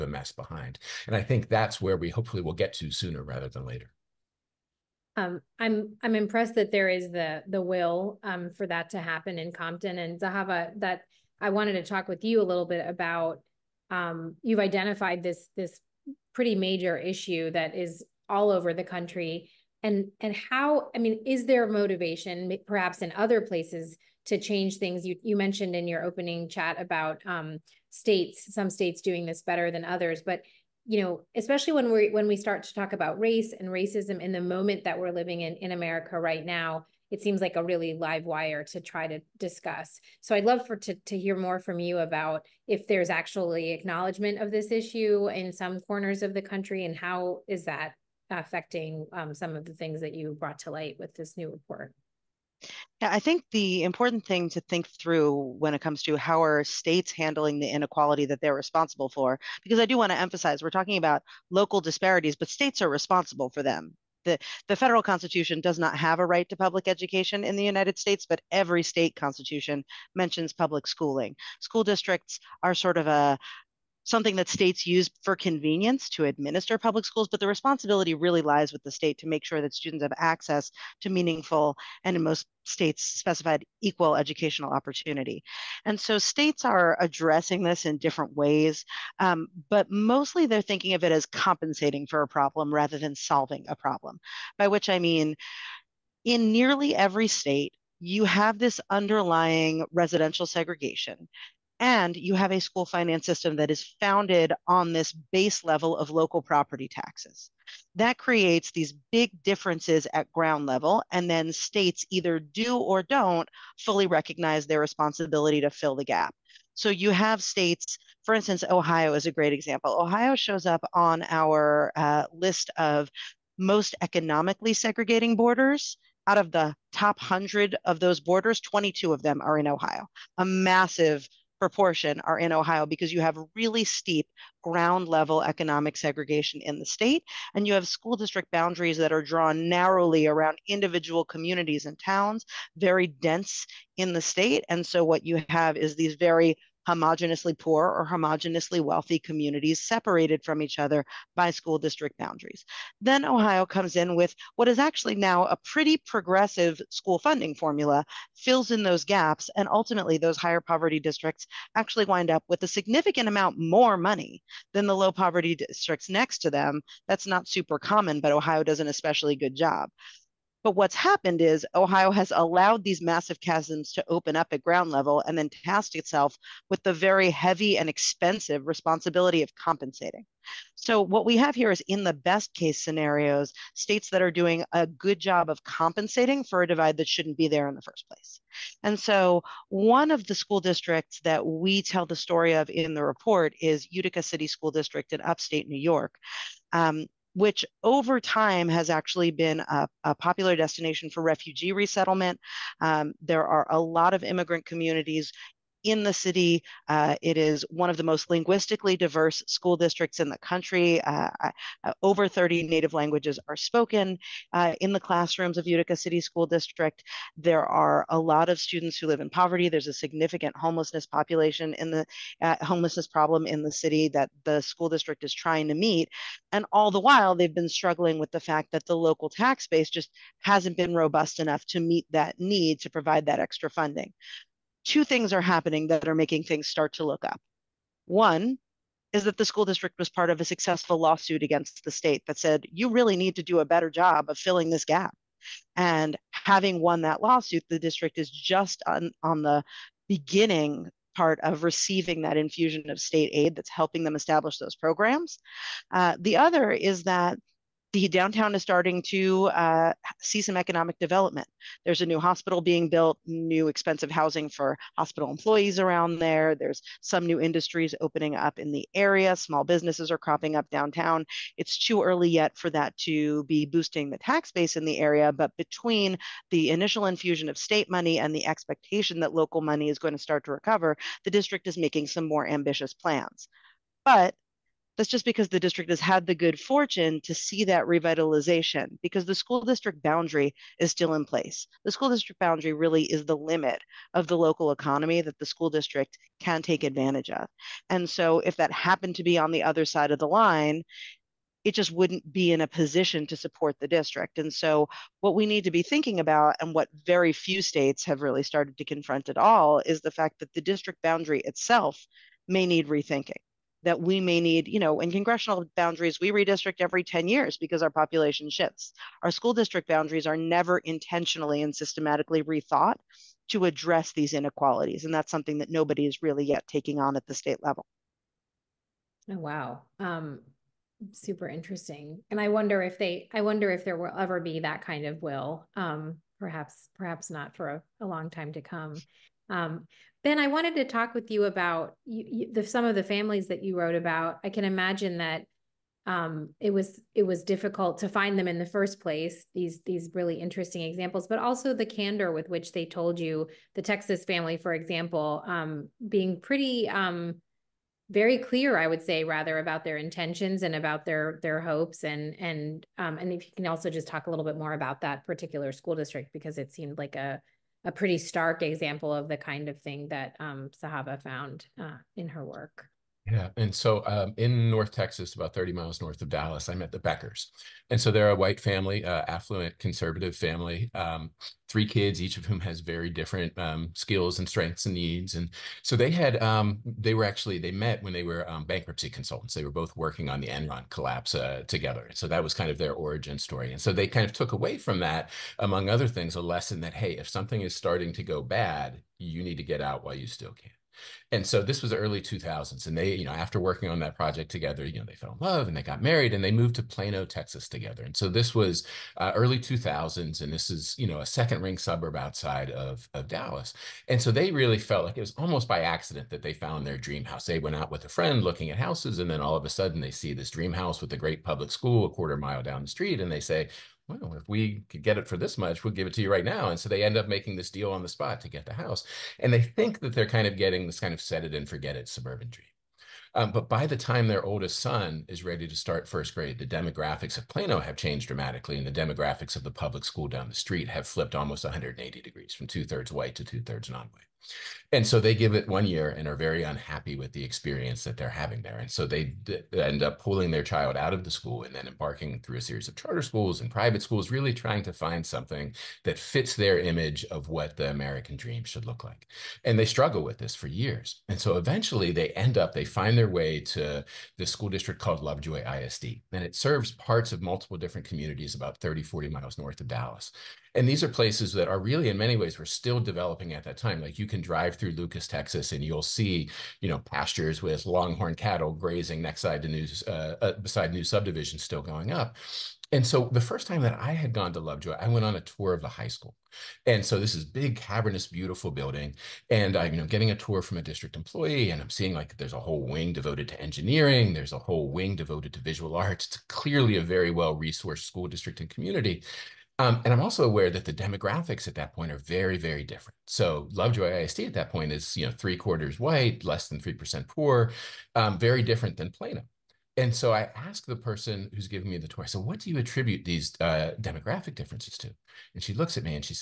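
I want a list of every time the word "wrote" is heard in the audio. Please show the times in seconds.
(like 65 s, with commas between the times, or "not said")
343 s.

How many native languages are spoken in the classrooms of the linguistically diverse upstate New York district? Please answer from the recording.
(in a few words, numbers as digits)
over 30.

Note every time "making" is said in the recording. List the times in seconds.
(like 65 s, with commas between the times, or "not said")
236 s, 281 s, 427 s.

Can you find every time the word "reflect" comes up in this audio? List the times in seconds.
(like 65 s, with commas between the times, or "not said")
not said.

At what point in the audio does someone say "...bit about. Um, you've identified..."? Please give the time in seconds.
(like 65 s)
12 s.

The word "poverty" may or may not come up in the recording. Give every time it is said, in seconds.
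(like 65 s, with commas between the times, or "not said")
160 s, 165 s, 219 s.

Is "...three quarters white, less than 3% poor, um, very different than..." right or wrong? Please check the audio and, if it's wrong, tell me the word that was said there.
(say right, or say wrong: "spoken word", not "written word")
right.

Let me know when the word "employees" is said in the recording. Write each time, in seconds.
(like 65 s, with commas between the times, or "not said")
265 s, 491 s.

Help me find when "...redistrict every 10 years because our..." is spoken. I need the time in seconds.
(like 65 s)
316 s.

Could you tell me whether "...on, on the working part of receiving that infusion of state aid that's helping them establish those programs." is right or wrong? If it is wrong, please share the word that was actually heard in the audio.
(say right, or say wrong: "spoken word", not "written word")
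wrong: "beginning", not "working".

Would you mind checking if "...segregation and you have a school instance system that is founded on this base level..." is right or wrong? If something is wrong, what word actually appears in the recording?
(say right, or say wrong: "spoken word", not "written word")
wrong: "finance", not "instance".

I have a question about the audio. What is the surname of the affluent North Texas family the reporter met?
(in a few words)
Beckers.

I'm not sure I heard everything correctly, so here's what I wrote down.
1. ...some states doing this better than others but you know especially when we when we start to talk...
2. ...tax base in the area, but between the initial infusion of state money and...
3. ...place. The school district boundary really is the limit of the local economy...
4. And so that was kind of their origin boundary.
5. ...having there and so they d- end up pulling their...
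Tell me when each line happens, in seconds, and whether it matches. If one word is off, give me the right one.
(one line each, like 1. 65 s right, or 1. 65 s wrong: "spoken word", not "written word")
1. 28 s right
2. 274 s right
3. 291 s right
4. 392 s wrong: "story", not "boundary"
5. 448 s right.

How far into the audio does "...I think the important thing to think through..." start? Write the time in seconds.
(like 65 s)
53 s.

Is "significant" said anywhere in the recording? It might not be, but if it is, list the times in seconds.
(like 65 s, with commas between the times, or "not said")
162 s, 219 s.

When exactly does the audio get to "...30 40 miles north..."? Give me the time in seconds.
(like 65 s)
468 s.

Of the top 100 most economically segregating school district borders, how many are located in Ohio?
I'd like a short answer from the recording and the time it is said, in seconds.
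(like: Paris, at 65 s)
22, at 128 s.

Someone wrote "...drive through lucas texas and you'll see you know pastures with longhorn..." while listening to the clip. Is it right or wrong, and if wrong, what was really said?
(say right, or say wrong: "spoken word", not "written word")
right.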